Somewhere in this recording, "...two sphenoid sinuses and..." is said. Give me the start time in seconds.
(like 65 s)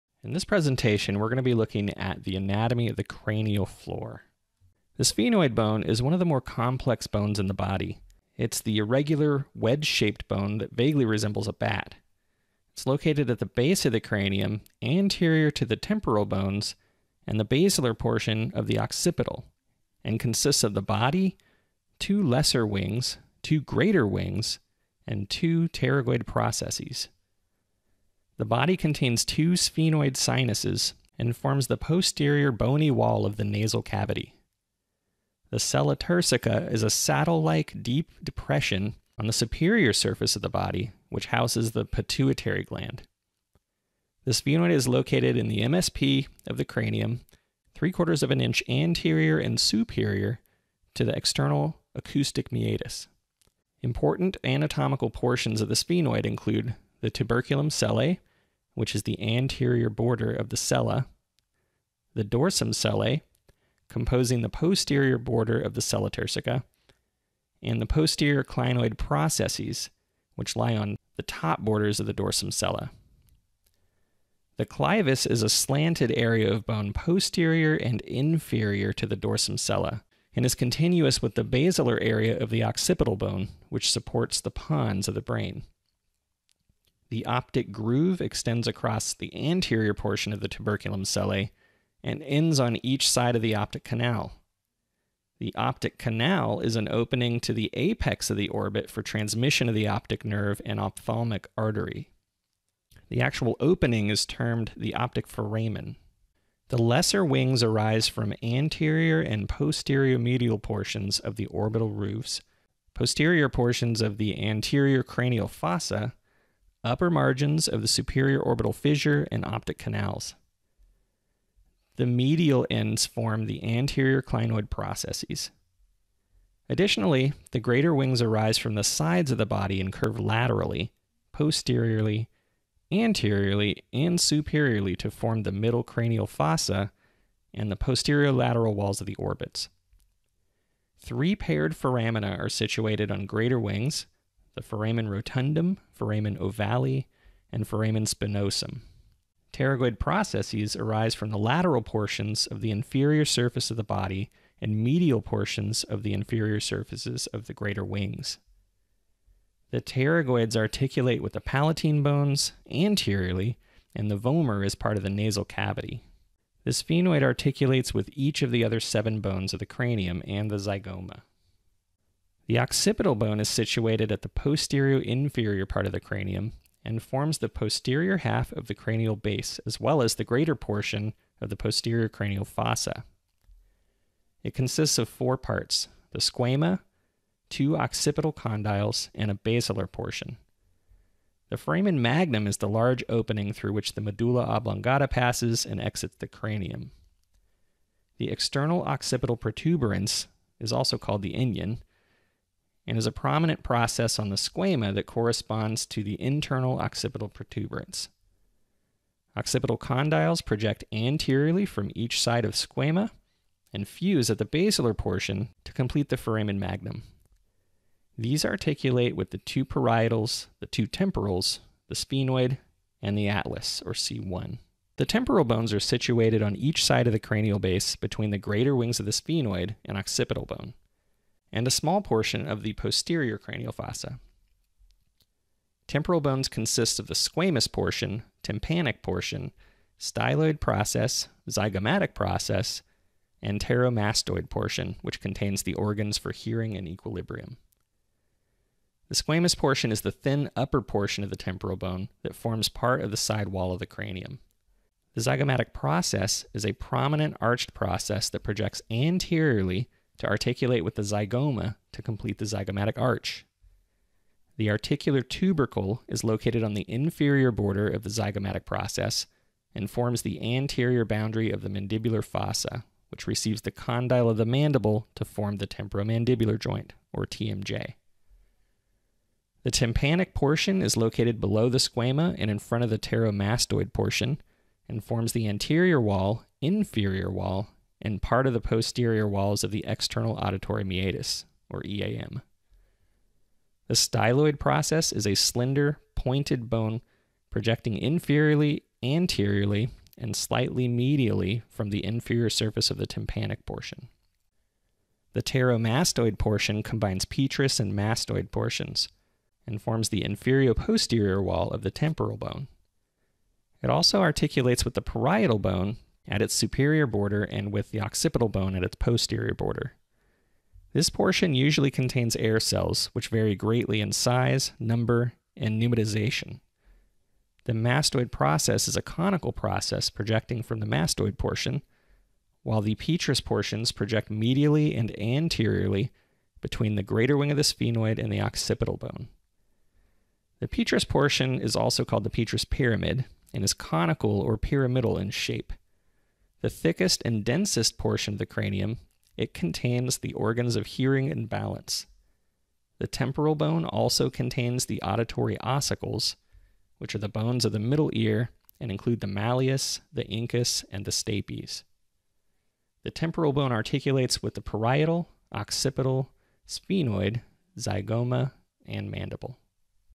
29 s.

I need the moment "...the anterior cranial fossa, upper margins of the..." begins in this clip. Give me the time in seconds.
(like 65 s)
114 s.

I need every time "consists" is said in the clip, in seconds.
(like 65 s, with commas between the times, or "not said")
20 s, 184 s, 236 s.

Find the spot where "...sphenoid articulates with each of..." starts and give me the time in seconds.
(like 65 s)
166 s.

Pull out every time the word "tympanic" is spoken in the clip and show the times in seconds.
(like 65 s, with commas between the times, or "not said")
238 s, 279 s, 303 s.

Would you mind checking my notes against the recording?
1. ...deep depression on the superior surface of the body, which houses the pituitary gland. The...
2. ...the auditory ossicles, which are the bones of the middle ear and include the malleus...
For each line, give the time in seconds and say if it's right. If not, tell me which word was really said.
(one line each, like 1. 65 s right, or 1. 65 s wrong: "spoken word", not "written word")
1. 37 s right
2. 354 s right.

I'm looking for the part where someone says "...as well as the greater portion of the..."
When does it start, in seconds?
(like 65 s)
179 s.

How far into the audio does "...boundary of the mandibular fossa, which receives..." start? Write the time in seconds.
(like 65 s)
271 s.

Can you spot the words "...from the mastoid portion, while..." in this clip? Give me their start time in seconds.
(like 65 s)
330 s.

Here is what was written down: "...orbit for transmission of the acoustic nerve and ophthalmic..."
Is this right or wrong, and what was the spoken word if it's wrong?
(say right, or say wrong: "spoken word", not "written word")
wrong: "optic", not "acoustic".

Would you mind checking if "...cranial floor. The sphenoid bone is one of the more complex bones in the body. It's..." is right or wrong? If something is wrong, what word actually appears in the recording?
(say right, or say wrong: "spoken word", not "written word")
right.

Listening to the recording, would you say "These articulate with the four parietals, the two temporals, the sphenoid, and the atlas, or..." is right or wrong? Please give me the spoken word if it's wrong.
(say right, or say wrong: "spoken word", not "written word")
wrong: "two", not "four".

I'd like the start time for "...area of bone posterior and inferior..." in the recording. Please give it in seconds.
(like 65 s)
76 s.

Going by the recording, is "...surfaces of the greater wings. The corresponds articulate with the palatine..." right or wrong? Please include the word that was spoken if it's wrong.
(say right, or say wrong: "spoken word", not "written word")
wrong: "pterygoids", not "corresponds".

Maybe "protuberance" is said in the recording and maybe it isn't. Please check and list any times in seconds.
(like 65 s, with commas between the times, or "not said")
199 s, 207 s.